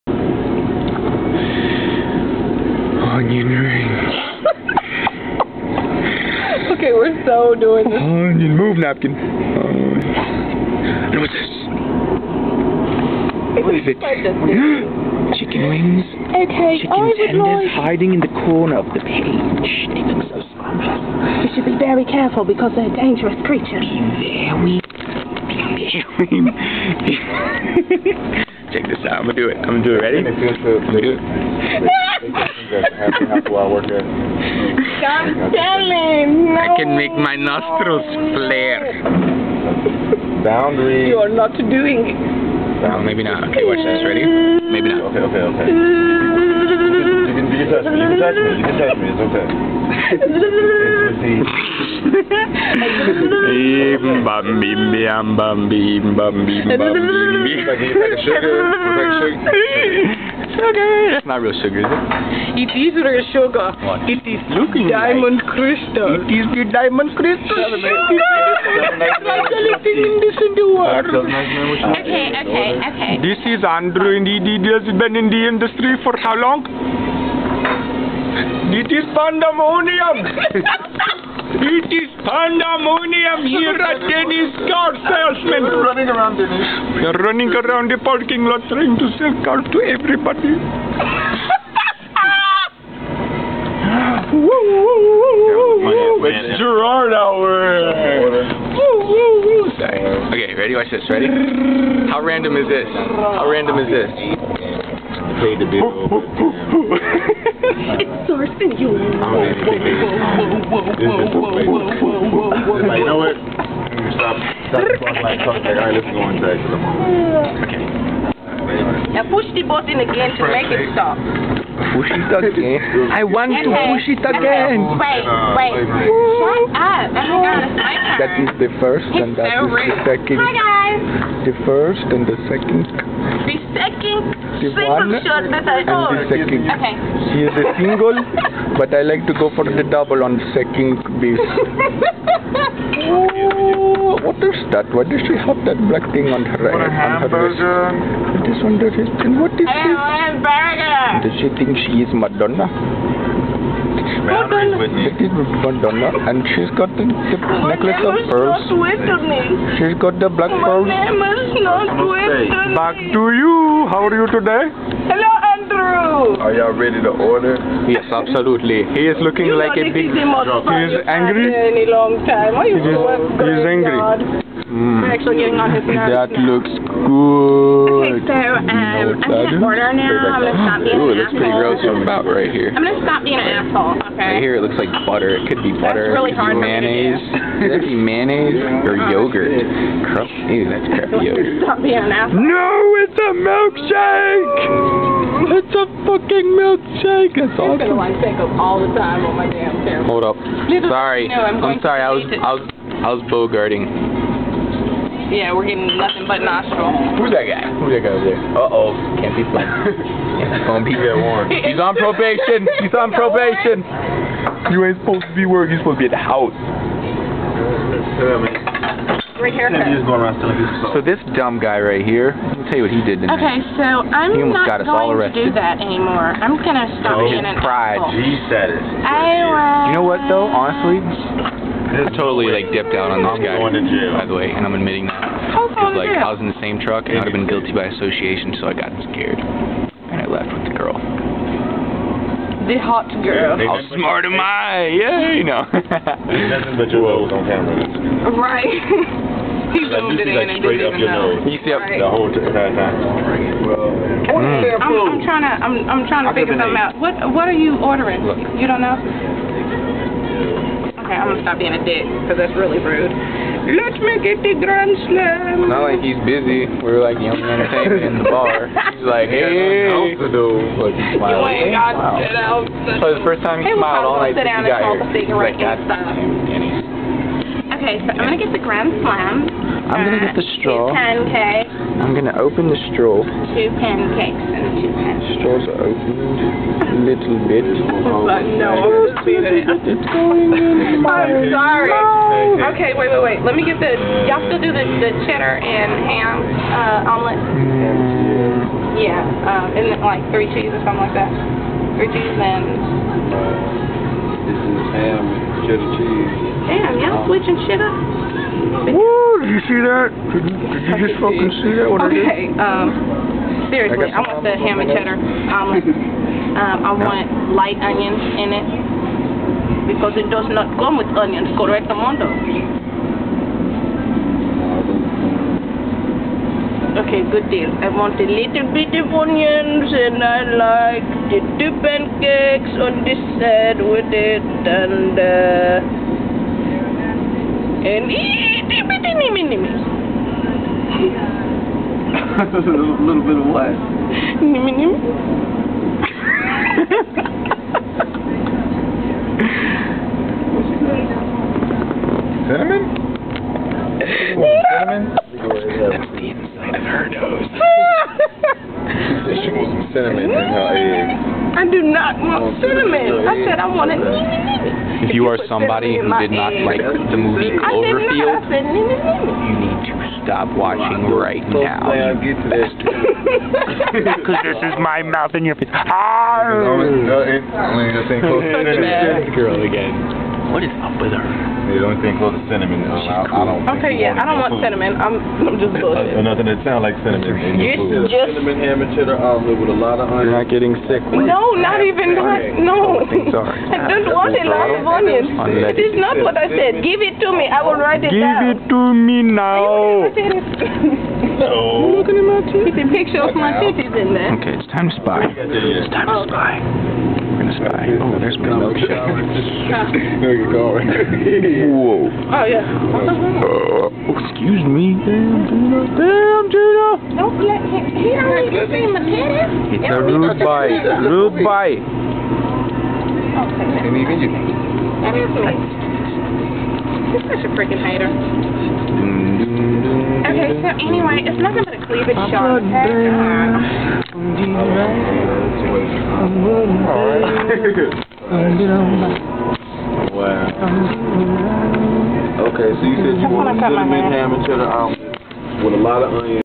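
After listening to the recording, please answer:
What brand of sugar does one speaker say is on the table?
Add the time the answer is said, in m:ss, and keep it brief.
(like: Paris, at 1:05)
Diamond Crystal, at 1:06.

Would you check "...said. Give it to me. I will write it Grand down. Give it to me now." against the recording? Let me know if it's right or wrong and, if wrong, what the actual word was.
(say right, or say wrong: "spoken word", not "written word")
wrong: "Give", not "Grand".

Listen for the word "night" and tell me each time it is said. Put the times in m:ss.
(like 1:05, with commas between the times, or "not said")
4:34.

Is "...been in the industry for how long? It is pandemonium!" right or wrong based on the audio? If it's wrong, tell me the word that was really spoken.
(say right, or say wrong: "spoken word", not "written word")
right.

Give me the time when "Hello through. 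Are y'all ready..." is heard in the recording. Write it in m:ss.
2:45.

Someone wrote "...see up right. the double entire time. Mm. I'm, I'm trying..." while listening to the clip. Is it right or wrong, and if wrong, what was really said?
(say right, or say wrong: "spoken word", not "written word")
wrong: "whole", not "double".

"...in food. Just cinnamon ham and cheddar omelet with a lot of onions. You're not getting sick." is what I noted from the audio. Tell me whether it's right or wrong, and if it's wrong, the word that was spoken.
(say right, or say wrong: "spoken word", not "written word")
right.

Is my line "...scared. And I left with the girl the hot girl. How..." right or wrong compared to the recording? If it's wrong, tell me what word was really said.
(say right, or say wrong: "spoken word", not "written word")
right.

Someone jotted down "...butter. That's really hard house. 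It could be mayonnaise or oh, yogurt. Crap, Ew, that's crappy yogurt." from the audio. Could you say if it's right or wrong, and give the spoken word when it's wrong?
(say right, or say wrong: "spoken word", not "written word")
wrong: "mayonnaise", not "house".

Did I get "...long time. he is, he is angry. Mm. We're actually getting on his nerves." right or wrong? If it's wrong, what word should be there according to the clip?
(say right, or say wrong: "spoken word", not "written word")
right.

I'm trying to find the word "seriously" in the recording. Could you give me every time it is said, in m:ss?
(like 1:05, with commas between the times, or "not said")
5:13.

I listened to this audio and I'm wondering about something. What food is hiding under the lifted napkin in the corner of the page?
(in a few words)
Chicken wings.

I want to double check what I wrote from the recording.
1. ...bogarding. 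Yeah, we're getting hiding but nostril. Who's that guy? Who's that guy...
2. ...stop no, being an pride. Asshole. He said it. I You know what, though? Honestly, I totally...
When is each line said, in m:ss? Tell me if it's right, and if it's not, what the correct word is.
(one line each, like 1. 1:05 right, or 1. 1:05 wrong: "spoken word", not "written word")
1. 3:23 wrong: "nothing", not "hiding"
2. 3:47 right.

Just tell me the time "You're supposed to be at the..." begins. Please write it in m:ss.
3:35.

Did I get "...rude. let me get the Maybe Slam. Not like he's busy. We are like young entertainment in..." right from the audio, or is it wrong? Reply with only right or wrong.
wrong.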